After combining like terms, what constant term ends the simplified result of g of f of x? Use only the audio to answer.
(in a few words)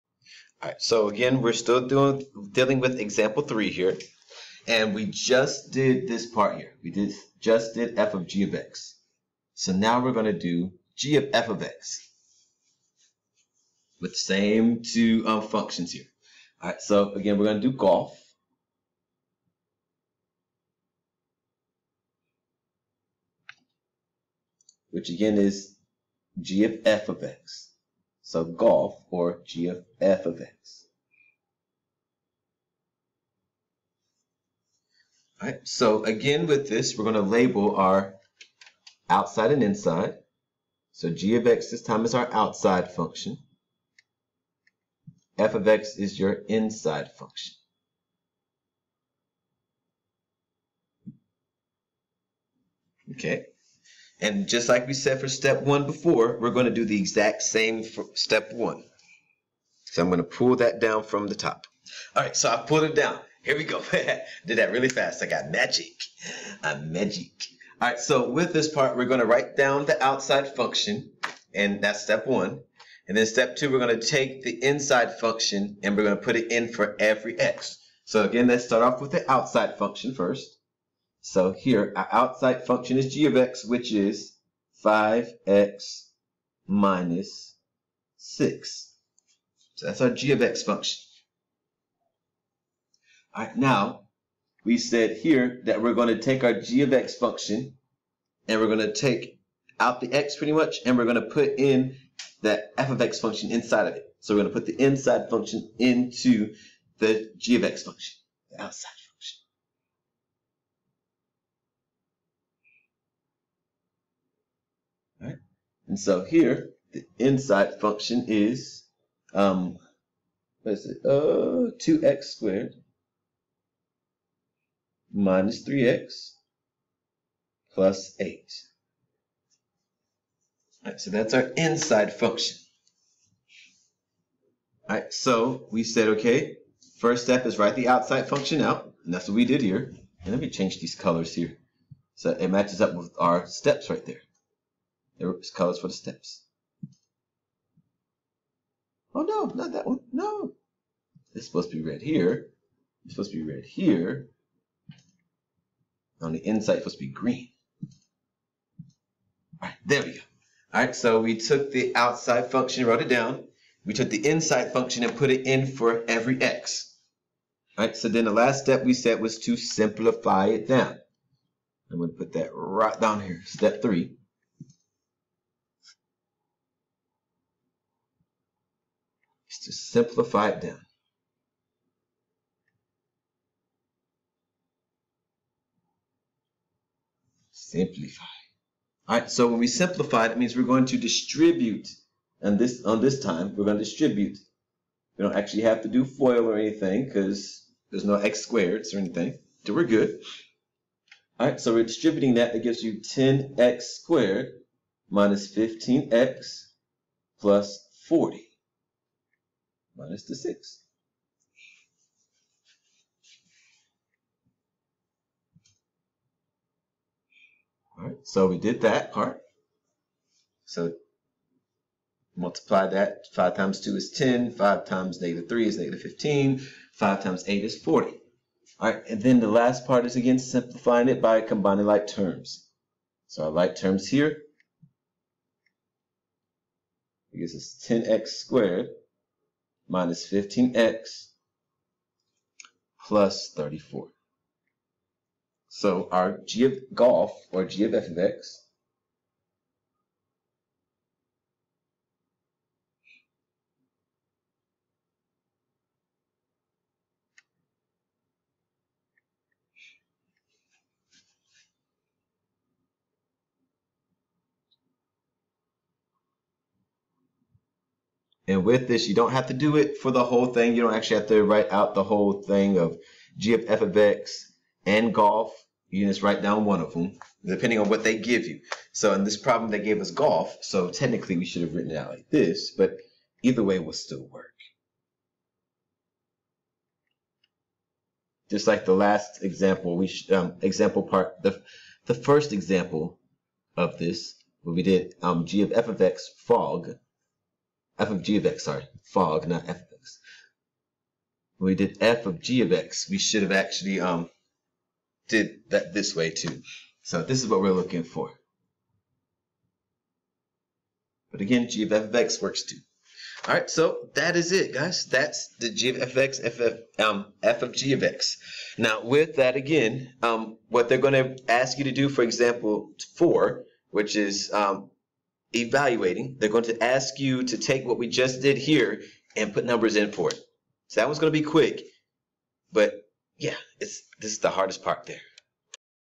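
34.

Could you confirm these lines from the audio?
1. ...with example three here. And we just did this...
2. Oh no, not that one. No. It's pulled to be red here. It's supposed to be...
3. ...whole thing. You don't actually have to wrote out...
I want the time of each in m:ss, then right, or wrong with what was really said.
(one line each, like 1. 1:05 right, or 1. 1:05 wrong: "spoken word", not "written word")
1. 0:02 right
2. 2:29 wrong: "supposed", not "pulled"
3. 4:30 wrong: "write", not "wrote".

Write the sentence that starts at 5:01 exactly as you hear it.
When we did f of g of x, we should have actually um, did that this way too.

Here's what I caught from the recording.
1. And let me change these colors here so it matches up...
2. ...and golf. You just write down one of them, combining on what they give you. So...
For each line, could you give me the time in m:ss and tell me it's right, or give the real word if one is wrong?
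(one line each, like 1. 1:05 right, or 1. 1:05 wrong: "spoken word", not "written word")
1. 2:20 right
2. 4:34 wrong: "depending", not "combining".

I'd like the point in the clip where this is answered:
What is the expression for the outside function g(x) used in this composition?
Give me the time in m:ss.
1:24.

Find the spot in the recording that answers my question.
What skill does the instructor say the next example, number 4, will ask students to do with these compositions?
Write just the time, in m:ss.
5:25.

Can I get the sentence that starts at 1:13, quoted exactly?
And then step two, we're going to take the inside function, and we're going to put it in for every x.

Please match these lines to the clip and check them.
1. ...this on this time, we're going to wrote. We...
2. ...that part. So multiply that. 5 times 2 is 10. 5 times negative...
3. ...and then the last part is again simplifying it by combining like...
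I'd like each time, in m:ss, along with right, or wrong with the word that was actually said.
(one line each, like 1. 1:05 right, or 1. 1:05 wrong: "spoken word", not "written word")
1. 3:12 wrong: "distribute", not "wrote"
2. 3:38 right
3. 3:49 right.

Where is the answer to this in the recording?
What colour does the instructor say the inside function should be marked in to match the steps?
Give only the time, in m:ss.
2:37.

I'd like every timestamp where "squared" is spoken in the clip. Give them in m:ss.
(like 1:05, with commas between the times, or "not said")
2:02, 3:18, 3:23, 3:58.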